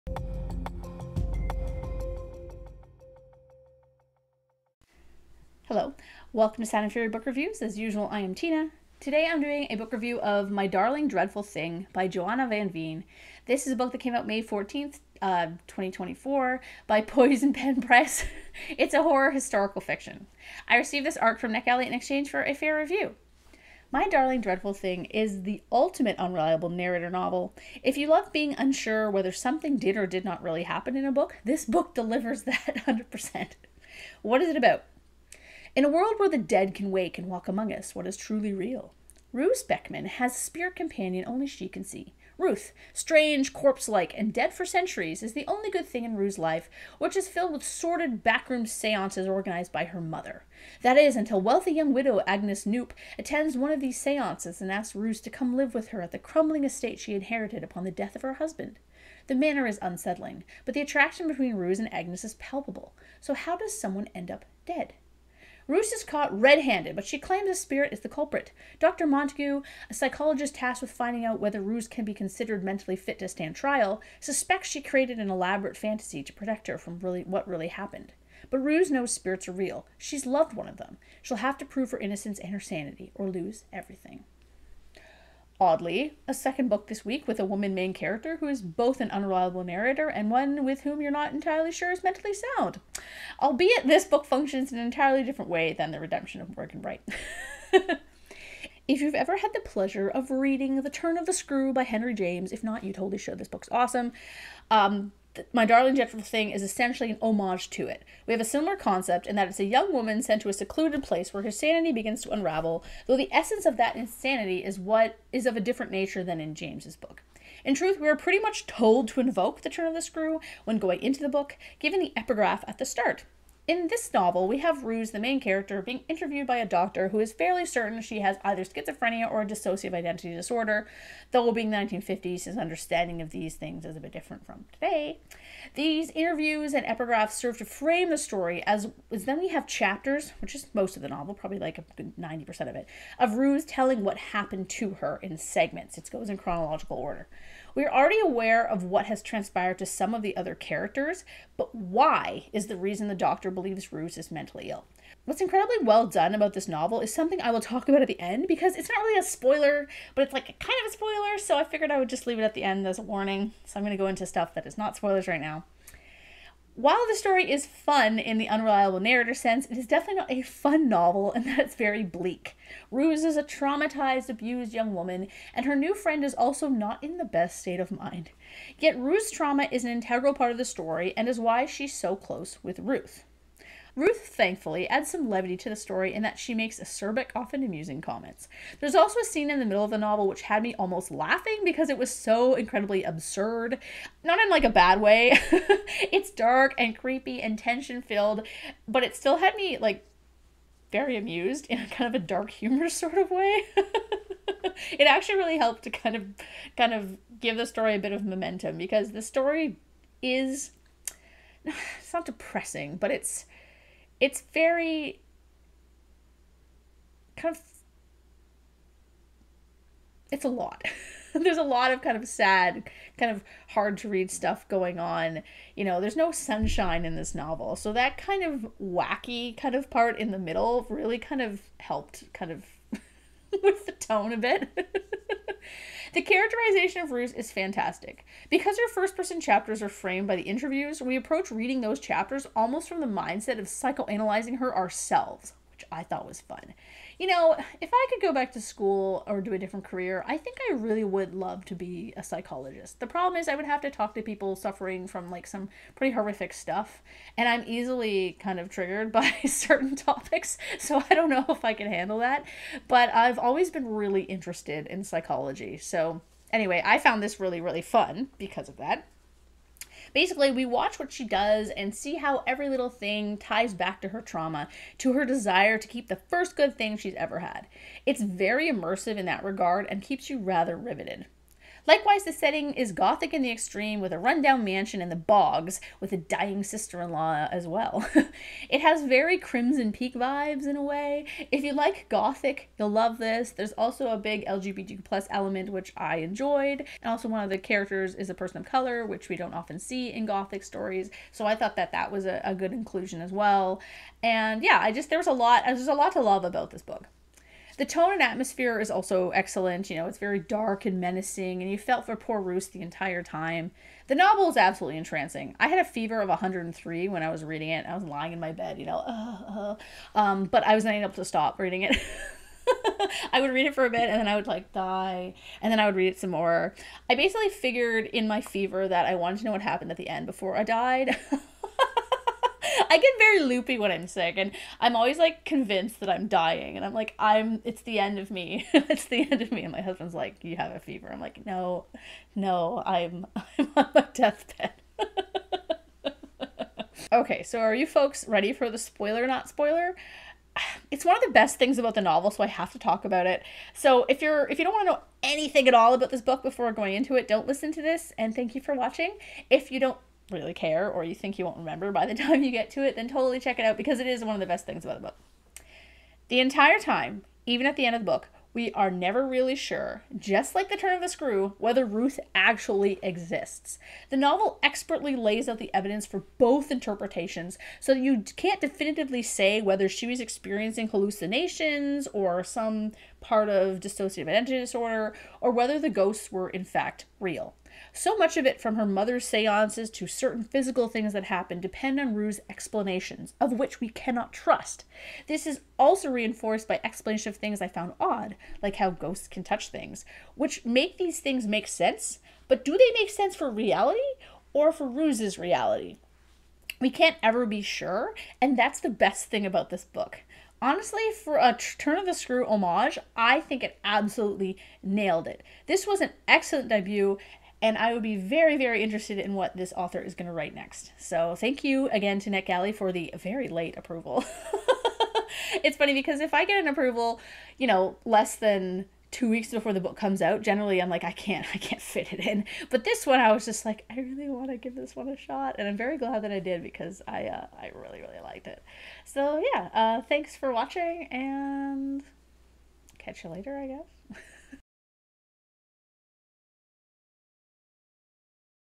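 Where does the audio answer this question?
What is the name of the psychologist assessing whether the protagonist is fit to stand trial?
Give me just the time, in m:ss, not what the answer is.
1:08.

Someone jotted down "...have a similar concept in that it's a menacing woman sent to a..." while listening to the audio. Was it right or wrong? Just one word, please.
wrong.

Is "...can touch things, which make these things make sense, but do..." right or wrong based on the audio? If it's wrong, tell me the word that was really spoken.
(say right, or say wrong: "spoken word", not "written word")
right.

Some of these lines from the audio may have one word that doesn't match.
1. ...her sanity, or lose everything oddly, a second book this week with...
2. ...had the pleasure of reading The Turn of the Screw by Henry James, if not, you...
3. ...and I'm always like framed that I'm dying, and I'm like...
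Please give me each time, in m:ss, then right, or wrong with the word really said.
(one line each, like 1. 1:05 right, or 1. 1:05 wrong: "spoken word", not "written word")
1. 1:22 right
2. 1:39 right
3. 5:34 wrong: "convinced", not "framed".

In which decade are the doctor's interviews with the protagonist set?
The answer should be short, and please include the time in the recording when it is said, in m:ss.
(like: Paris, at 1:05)
1950s, at 2:11.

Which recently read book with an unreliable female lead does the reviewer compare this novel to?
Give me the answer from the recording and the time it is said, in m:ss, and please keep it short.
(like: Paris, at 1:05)
The Redemption of Morgan Bright, at 1:35.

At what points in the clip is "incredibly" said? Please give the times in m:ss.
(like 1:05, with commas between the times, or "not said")
2:35, 3:12.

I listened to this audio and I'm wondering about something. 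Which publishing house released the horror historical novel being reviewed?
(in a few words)
Poison Pen Press.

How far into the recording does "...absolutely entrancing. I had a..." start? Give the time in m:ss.
5:14.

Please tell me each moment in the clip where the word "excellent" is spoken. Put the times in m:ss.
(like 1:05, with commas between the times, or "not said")
5:09, 6:56.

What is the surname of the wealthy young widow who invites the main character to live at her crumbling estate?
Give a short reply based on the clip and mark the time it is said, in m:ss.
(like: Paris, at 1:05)
Knoop, at 0:52.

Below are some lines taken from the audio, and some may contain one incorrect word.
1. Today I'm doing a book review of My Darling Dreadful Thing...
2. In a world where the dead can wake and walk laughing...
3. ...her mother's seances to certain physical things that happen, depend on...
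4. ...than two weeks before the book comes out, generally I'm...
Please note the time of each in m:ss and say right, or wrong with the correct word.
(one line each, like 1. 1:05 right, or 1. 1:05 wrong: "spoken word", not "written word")
1. 0:08 right
2. 0:35 wrong: "among", not "laughing"
3. 6:28 right
4. 7:08 right.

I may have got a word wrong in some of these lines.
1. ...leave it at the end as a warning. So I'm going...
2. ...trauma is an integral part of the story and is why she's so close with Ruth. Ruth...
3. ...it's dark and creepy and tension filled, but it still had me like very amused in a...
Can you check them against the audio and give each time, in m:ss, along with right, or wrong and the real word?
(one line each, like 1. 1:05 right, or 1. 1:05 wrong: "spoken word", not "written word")
1. 2:42 right
2. 2:59 right
3. 3:16 right.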